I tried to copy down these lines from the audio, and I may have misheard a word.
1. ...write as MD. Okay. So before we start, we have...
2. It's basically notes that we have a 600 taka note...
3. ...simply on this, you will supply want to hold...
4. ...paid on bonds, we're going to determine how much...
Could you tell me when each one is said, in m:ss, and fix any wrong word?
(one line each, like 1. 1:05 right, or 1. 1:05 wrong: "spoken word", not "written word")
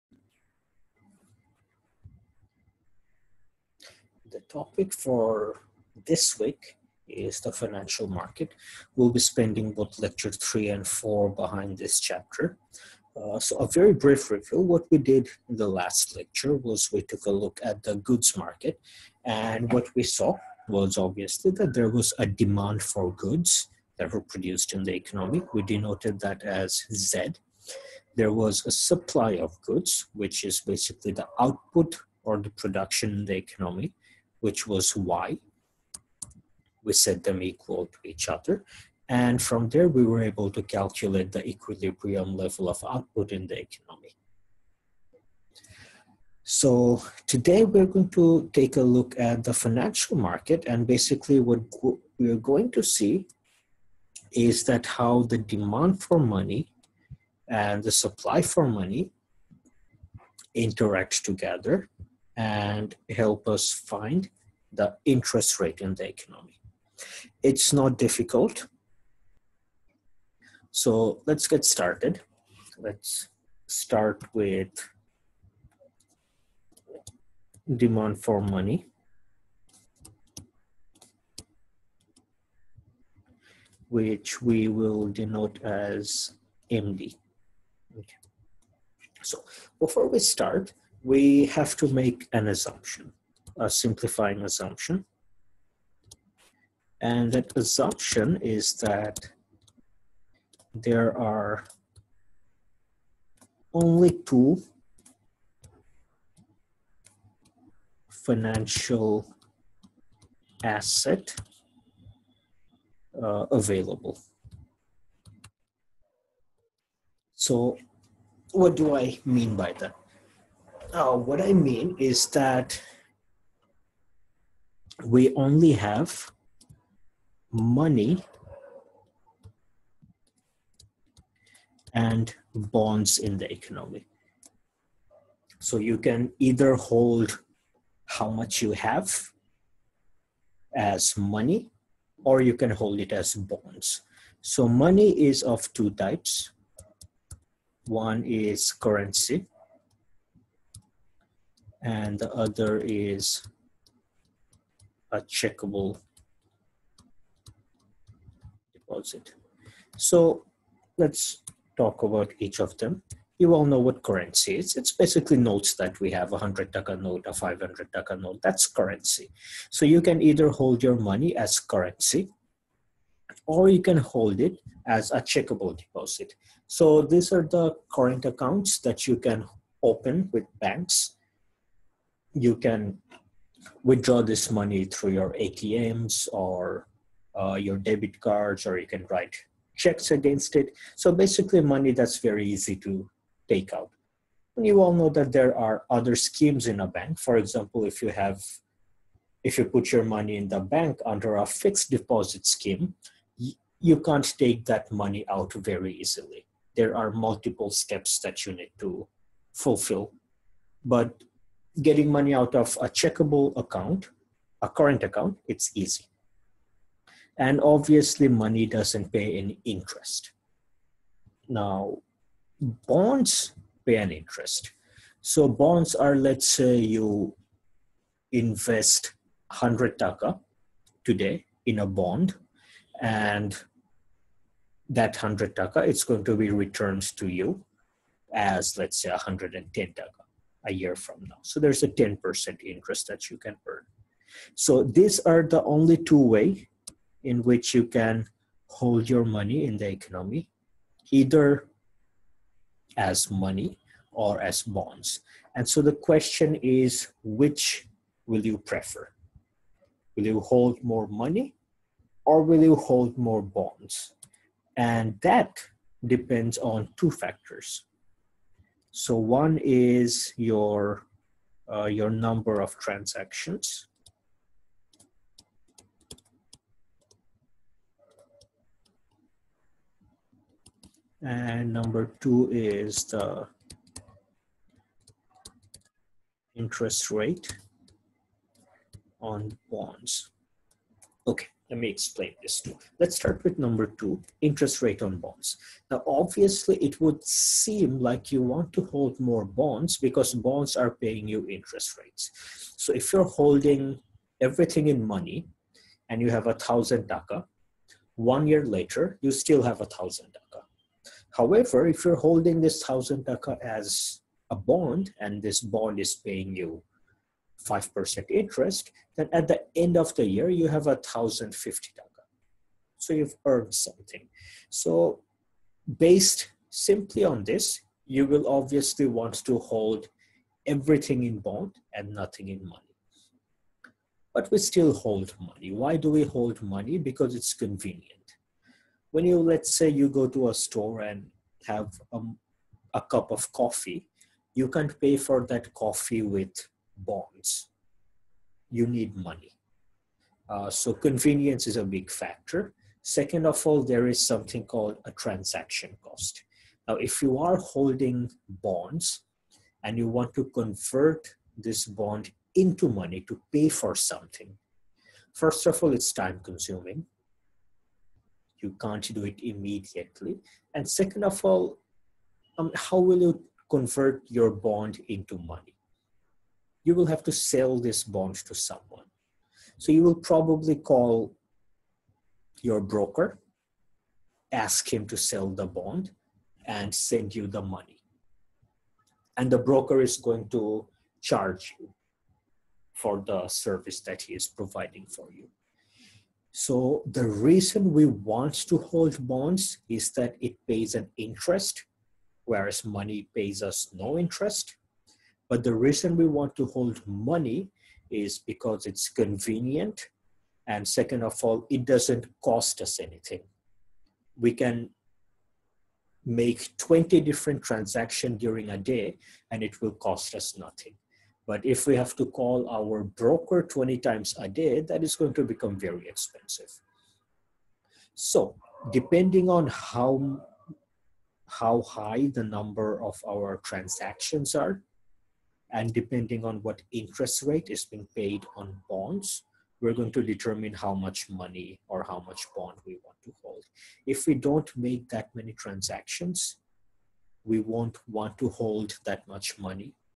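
1. 1:25 wrong: "denote", not "write"
2. 2:44 wrong: "100", not "600"
3. 5:26 wrong: "obviously", not "supply"
4. 7:18 right.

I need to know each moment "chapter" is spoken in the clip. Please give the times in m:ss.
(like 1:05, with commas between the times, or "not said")
0:11.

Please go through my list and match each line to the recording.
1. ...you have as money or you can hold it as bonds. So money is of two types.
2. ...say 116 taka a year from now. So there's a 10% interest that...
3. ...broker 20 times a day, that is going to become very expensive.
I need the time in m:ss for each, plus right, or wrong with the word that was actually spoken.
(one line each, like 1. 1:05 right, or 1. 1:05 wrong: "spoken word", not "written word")
1. 2:18 right
2. 3:59 wrong: "110", not "116"
3. 7:03 right.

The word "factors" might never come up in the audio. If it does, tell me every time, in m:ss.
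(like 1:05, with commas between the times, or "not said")
4:27, 5:52.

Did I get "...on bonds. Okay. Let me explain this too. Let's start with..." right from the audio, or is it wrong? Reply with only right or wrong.
right.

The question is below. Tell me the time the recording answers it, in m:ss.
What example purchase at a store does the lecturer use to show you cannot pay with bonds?
5:42.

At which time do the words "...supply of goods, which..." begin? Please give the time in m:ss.
0:28.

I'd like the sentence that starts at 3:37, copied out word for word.
And obviously, money doesn't pay any interest.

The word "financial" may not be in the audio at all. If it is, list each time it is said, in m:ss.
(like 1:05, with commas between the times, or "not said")
0:07, 0:49, 1:48.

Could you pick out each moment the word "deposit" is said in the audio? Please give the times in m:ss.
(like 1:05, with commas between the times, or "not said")
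2:38, 2:55, 3:21.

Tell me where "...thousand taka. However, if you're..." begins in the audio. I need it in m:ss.
5:09.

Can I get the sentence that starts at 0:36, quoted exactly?
We set them equal to each other.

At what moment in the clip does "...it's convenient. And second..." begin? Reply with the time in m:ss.
6:48.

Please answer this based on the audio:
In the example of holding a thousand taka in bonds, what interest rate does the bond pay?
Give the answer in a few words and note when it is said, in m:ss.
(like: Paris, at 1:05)
5%, at 5:17.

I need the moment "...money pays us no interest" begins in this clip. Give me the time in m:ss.
6:42.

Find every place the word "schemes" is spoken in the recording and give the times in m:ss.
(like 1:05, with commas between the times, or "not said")
3:16, 3:22.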